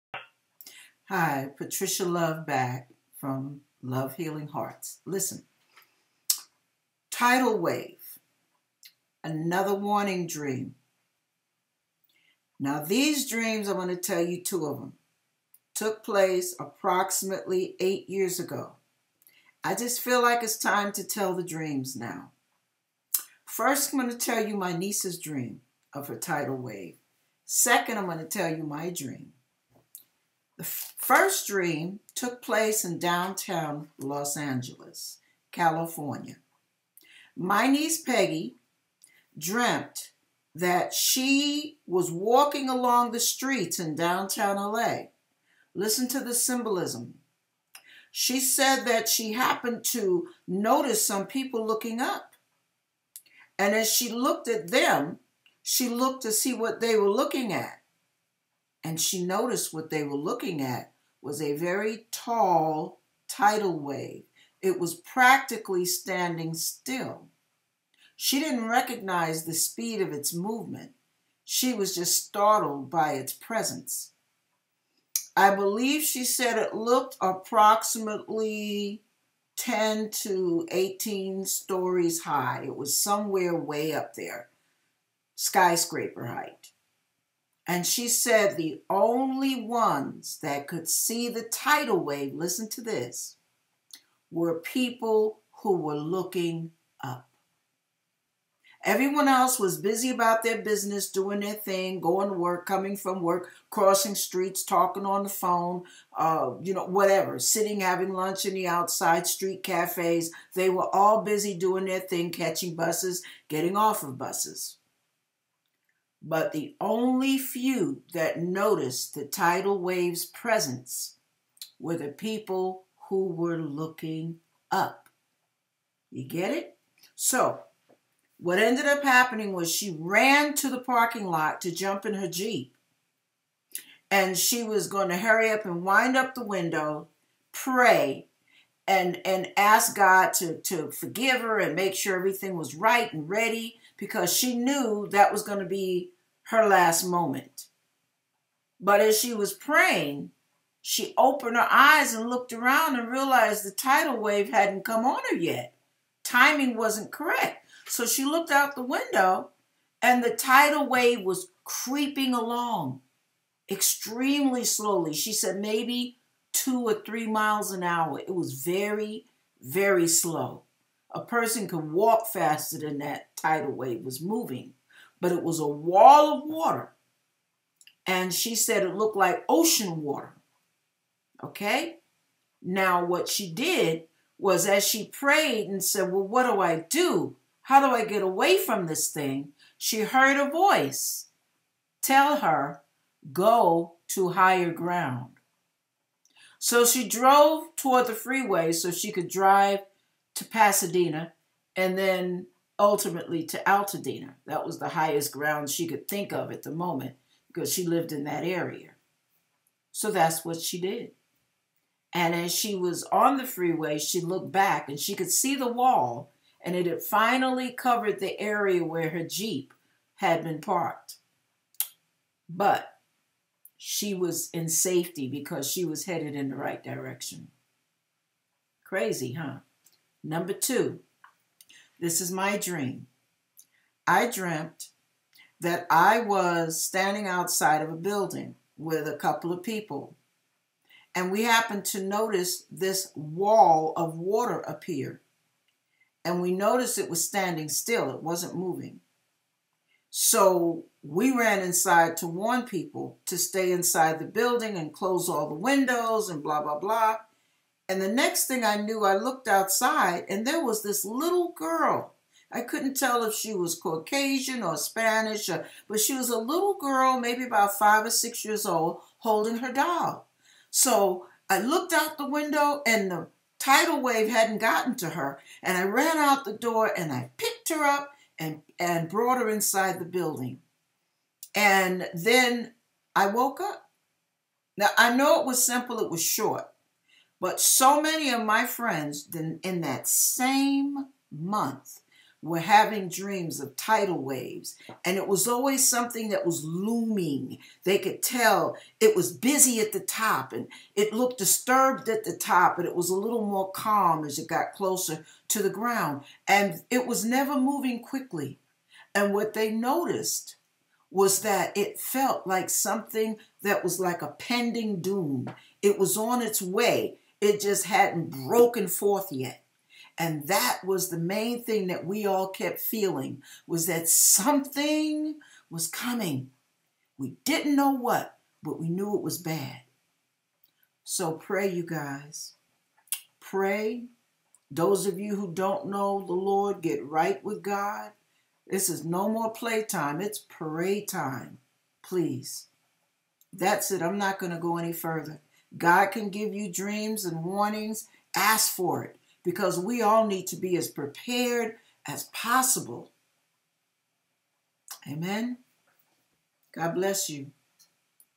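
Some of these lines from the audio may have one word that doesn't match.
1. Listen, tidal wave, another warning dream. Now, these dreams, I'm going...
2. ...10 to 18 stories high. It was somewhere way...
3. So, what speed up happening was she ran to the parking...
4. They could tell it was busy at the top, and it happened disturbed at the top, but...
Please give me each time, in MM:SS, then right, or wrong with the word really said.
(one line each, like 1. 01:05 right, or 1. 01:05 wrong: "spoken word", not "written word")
1. 00:05 right
2. 01:19 right
3. 02:07 wrong: "ended", not "speed"
4. 04:57 wrong: "looked", not "happened".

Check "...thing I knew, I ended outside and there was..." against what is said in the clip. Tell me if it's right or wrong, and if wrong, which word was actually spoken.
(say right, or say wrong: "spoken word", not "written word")
wrong: "looked", not "ended".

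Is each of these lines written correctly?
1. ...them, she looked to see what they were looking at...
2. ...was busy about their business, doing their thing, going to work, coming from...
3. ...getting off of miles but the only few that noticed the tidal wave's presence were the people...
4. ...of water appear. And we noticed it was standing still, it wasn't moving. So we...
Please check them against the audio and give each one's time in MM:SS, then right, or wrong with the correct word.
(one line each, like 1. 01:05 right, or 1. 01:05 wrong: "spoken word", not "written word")
1. 00:54 right
2. 01:39 right
3. 01:53 wrong: "buses", not "miles"
4. 04:03 right.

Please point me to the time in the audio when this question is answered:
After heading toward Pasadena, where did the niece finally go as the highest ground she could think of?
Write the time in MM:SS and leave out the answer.
03:23.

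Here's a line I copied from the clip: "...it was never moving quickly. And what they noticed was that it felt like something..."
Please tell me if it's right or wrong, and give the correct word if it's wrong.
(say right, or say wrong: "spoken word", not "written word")
right.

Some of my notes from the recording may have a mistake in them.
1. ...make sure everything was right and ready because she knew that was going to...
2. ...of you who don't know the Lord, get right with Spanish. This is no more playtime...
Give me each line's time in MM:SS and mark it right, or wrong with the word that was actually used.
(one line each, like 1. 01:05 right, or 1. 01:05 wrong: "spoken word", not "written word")
1. 02:21 right
2. 05:35 wrong: "God", not "Spanish".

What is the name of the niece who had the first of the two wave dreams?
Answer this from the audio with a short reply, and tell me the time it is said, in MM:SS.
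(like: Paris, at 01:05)
Peggy, at 00:37.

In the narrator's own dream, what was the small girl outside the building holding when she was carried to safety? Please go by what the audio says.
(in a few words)
her doll.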